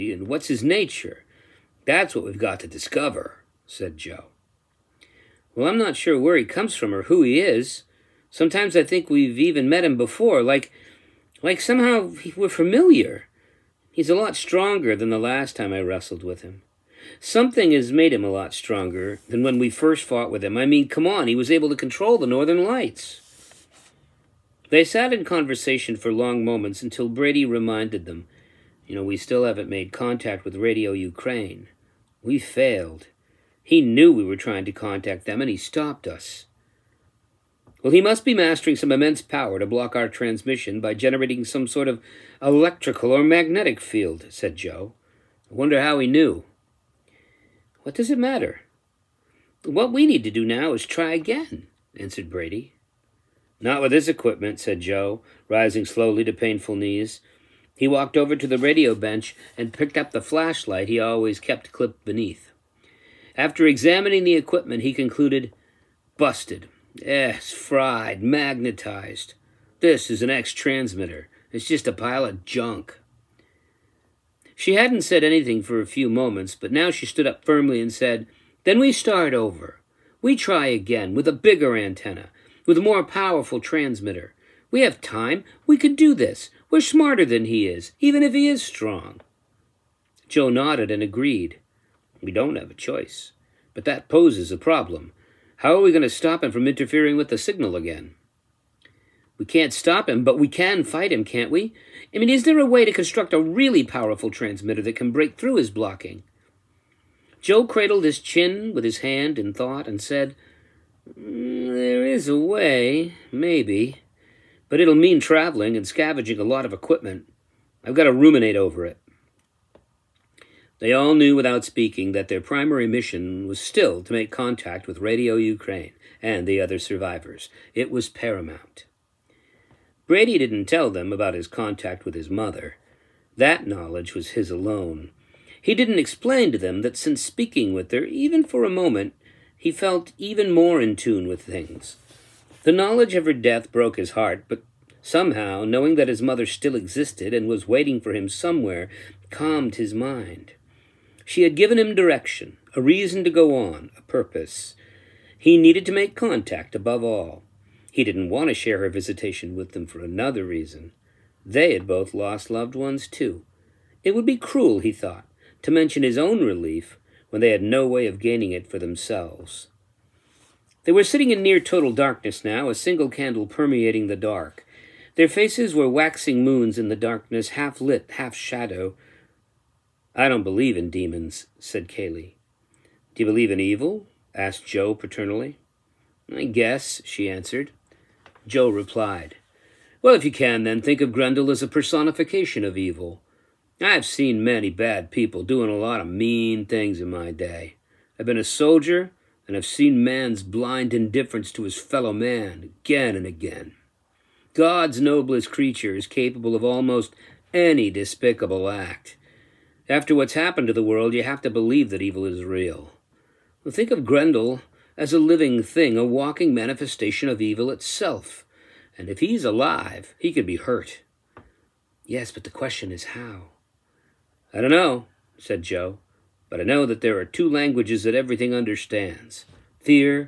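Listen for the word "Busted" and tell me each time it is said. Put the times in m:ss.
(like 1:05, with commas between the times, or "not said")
1:06.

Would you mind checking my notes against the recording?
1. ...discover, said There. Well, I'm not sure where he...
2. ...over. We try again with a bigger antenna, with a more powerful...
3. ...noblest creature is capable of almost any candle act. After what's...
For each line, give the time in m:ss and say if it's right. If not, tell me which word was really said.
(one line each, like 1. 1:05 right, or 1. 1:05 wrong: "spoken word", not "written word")
1. 0:02 wrong: "Joe", not "There"
2. 1:19 right
3. 3:24 wrong: "despicable", not "candle".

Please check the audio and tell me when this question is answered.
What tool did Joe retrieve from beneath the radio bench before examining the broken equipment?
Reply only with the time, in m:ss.
1:00.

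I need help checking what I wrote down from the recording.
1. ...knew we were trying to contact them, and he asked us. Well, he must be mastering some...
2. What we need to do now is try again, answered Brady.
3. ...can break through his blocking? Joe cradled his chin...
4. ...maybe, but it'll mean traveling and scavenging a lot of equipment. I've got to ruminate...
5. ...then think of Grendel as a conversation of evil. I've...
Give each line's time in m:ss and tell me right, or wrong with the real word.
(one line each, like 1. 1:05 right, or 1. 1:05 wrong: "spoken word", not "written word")
1. 0:33 wrong: "stopped", not "asked"
2. 0:49 right
3. 1:44 right
4. 1:53 right
5. 3:10 wrong: "personification", not "conversation".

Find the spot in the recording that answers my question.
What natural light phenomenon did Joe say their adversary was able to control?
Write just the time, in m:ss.
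0:22.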